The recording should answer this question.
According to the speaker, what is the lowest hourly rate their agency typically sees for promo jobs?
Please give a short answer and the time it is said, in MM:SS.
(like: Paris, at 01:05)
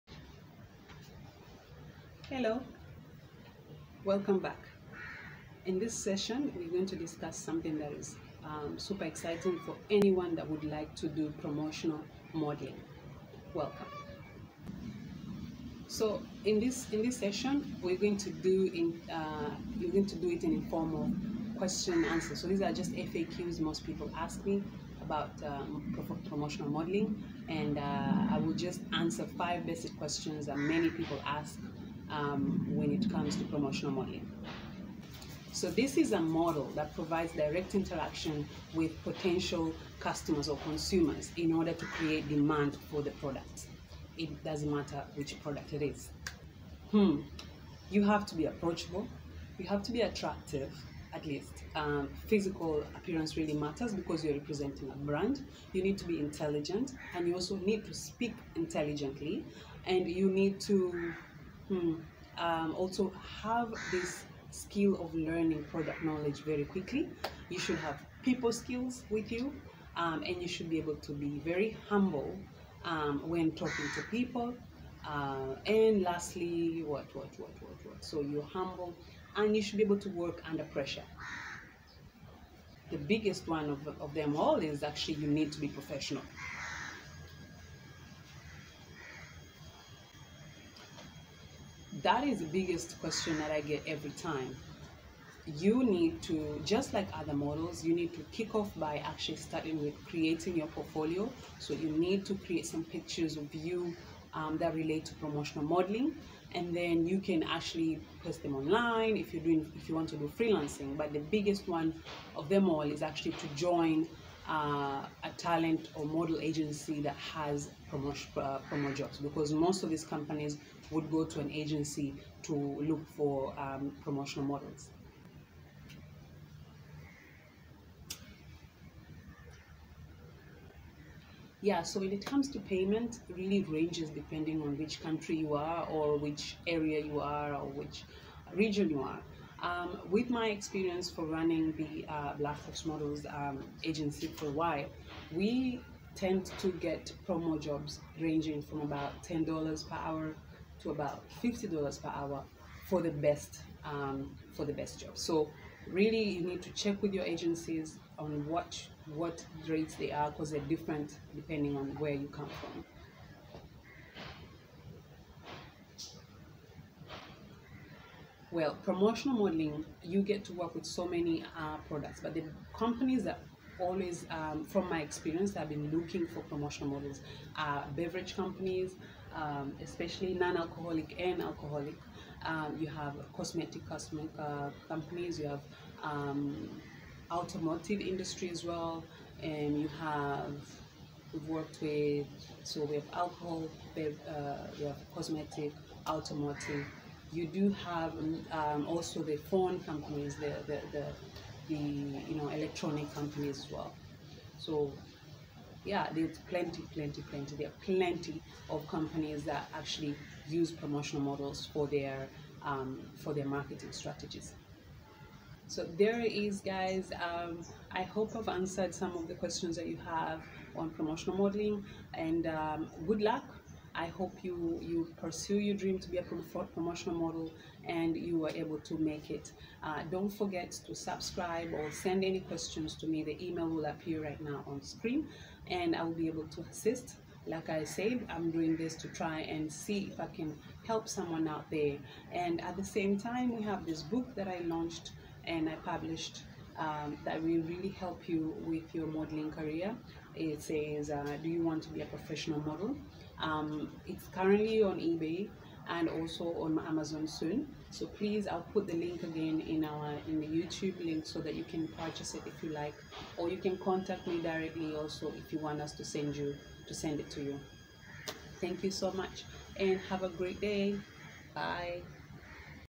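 $10 per hour, at 02:29.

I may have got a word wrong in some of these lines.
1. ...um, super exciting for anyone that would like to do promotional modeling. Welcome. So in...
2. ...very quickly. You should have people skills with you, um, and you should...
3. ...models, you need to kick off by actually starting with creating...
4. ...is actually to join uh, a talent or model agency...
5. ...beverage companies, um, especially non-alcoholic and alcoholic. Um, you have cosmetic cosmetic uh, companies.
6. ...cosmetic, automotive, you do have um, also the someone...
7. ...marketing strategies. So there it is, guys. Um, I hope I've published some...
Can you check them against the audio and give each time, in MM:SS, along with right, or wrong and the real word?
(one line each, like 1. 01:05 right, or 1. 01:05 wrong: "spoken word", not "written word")
1. 00:08 right
2. 01:06 right
3. 01:37 right
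4. 01:52 right
5. 02:57 right
6. 03:15 wrong: "phone", not "someone"
7. 03:33 wrong: "answered", not "published".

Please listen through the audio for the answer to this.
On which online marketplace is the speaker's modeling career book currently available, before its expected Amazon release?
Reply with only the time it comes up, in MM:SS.
04:14.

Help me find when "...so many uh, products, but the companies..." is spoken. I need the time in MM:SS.
02:50.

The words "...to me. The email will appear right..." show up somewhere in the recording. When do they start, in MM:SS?
03:52.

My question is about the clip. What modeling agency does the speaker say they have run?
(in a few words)
Blackfox Models.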